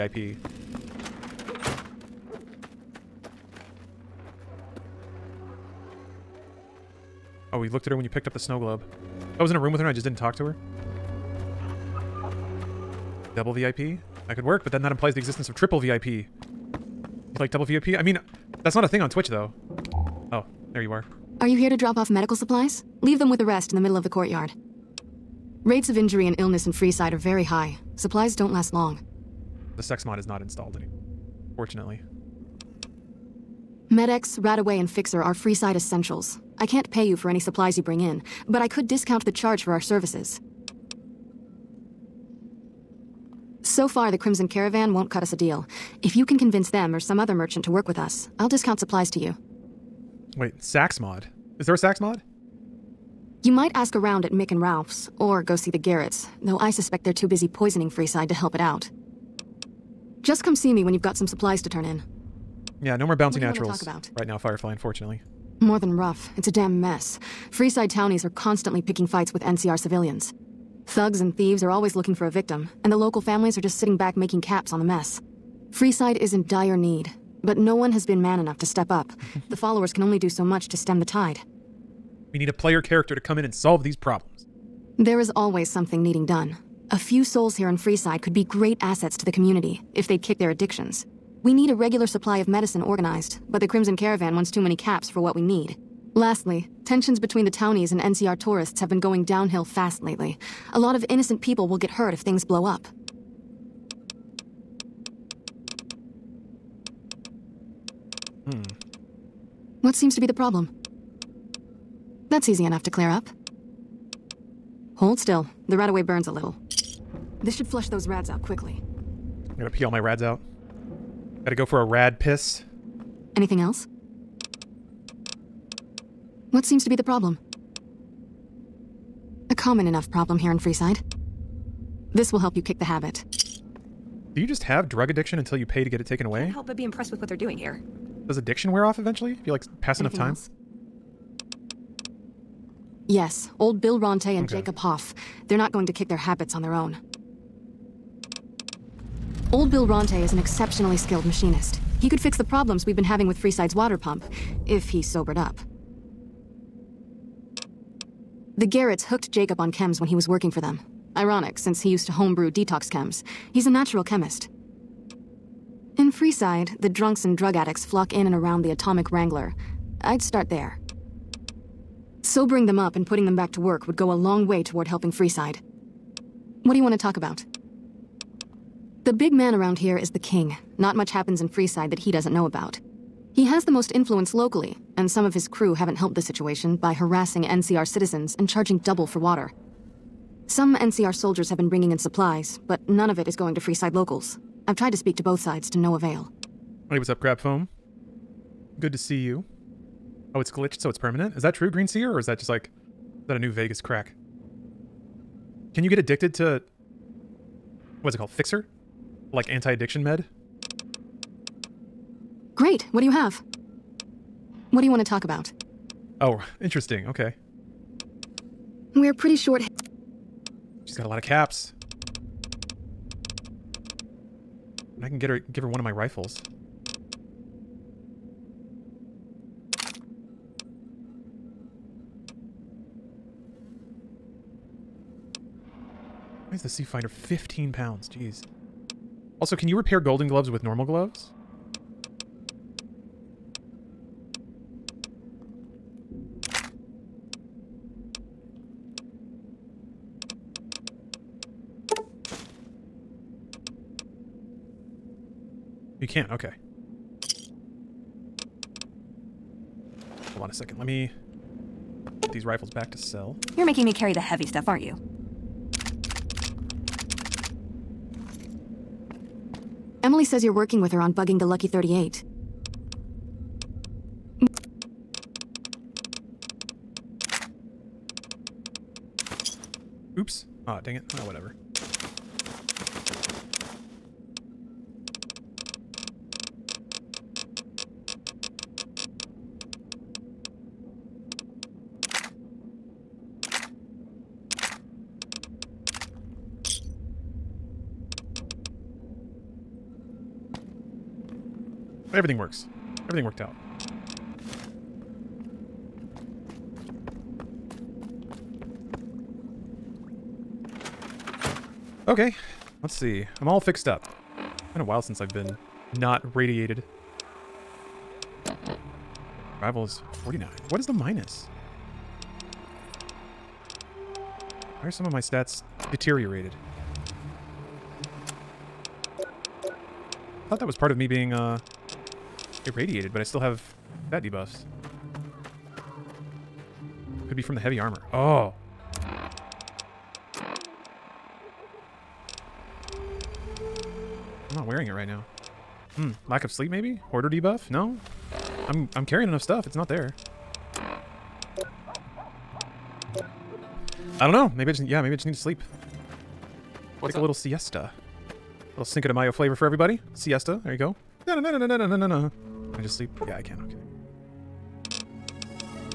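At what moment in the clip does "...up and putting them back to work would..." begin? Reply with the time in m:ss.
2:52.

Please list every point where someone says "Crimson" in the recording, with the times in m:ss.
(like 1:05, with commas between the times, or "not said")
0:44, 1:33.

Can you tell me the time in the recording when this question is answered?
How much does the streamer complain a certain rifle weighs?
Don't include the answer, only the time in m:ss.
3:57.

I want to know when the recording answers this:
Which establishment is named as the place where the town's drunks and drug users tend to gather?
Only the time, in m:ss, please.
2:48.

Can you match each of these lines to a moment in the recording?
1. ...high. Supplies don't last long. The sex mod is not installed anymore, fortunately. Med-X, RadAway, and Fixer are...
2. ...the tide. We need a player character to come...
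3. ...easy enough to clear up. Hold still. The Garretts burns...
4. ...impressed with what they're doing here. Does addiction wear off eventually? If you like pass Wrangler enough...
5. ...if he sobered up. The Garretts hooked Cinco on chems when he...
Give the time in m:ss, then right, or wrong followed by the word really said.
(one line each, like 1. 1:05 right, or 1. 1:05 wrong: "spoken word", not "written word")
1. 0:27 right
2. 1:21 right
3. 1:52 wrong: "RadAway", not "Garretts"
4. 2:16 wrong: "Anything", not "Wrangler"
5. 2:34 wrong: "Jacob", not "Cinco".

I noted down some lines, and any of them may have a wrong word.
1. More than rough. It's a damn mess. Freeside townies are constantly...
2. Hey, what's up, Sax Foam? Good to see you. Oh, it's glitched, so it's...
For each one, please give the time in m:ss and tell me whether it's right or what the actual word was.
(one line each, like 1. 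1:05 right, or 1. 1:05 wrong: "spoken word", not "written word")
1. 1:05 right
2. 3:16 wrong: "Crab", not "Sax".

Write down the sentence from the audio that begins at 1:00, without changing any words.
Just come see me when you've got some supplies to turn in.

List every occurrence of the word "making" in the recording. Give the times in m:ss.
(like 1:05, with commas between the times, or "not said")
1:14, 4:23.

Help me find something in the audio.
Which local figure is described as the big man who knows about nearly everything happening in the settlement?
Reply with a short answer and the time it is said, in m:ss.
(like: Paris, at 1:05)
The King, at 3:00.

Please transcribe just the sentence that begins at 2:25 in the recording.
They're not going to kick their habits on their own.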